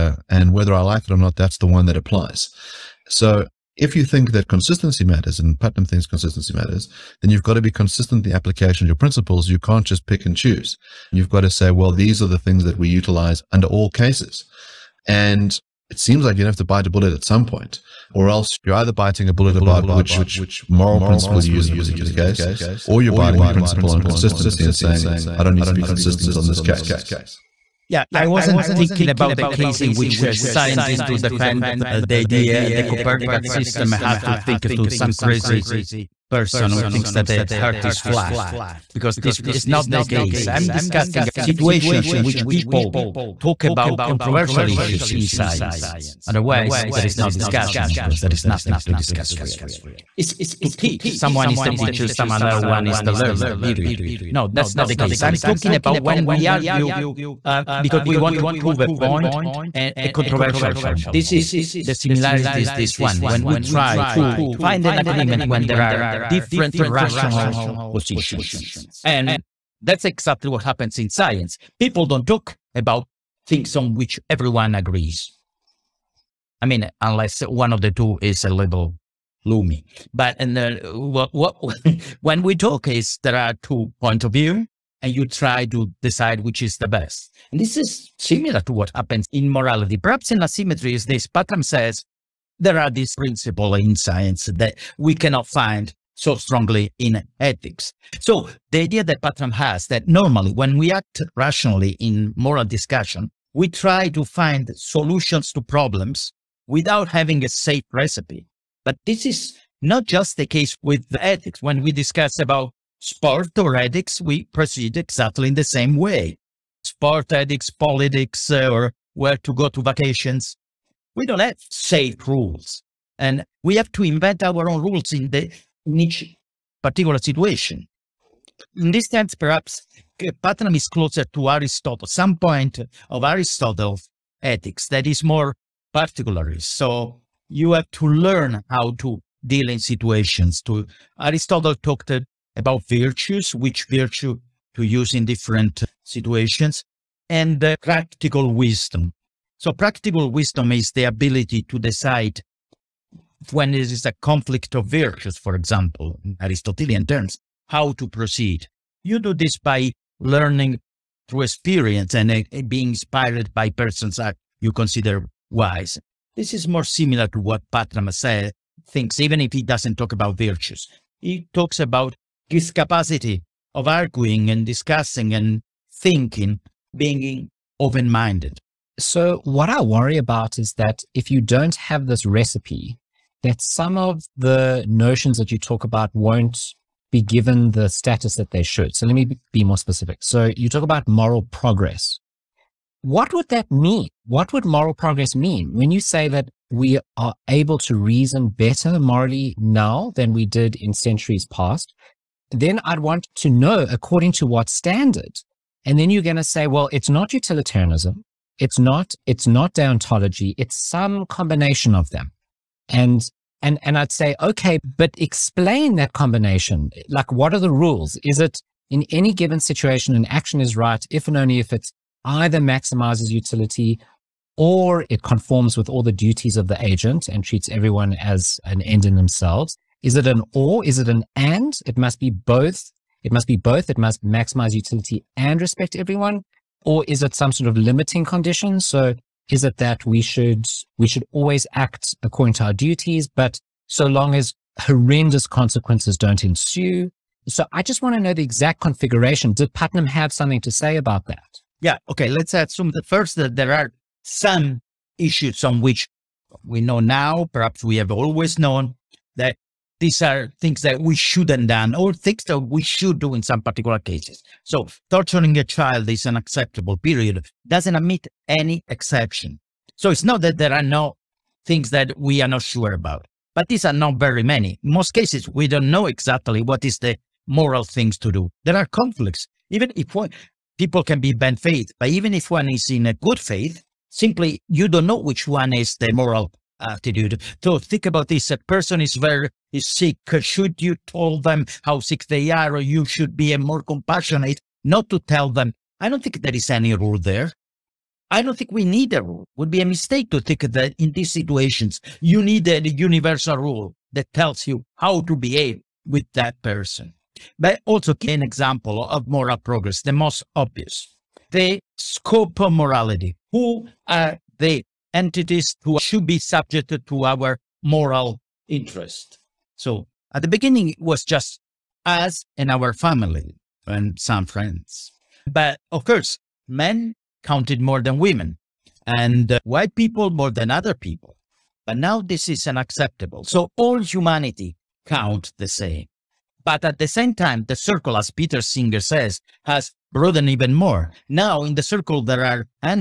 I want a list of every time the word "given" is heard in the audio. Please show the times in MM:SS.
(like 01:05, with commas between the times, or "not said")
03:07, 03:39.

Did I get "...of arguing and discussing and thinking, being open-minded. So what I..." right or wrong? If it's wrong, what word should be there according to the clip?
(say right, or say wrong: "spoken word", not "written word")
right.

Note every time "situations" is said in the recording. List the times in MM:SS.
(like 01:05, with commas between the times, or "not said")
00:41, 02:07, 02:19, 02:26, 03:39, 05:01.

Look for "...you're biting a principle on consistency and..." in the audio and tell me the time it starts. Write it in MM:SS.
00:23.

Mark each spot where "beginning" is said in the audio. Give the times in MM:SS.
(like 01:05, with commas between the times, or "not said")
05:20.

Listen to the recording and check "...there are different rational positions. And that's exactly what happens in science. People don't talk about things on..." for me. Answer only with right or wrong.
right.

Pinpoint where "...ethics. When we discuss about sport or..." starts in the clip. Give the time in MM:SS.
01:51.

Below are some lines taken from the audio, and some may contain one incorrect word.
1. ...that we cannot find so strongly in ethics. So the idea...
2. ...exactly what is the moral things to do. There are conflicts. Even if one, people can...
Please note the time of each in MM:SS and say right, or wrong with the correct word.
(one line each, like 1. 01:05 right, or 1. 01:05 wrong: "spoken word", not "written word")
1. 01:34 right
2. 04:36 right.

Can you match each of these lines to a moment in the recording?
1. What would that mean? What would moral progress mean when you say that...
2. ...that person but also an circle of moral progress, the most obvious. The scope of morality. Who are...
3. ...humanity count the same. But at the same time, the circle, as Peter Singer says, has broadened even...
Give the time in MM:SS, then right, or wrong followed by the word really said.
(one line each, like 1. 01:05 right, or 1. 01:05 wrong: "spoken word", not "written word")
1. 03:13 right
2. 05:06 wrong: "example", not "circle"
3. 05:34 right.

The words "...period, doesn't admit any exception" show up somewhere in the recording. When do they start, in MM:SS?
04:26.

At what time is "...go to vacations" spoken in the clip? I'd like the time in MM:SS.
01:59.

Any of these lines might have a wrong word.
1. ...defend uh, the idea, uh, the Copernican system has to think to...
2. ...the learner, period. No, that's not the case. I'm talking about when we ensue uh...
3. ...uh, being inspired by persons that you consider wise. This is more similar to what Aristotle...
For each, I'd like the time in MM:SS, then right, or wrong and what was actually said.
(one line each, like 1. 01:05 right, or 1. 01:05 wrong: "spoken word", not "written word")
1. 00:31 right
2. 00:53 wrong: "argue", not "ensue"
3. 02:42 wrong: "Patramasa", not "Aristotle".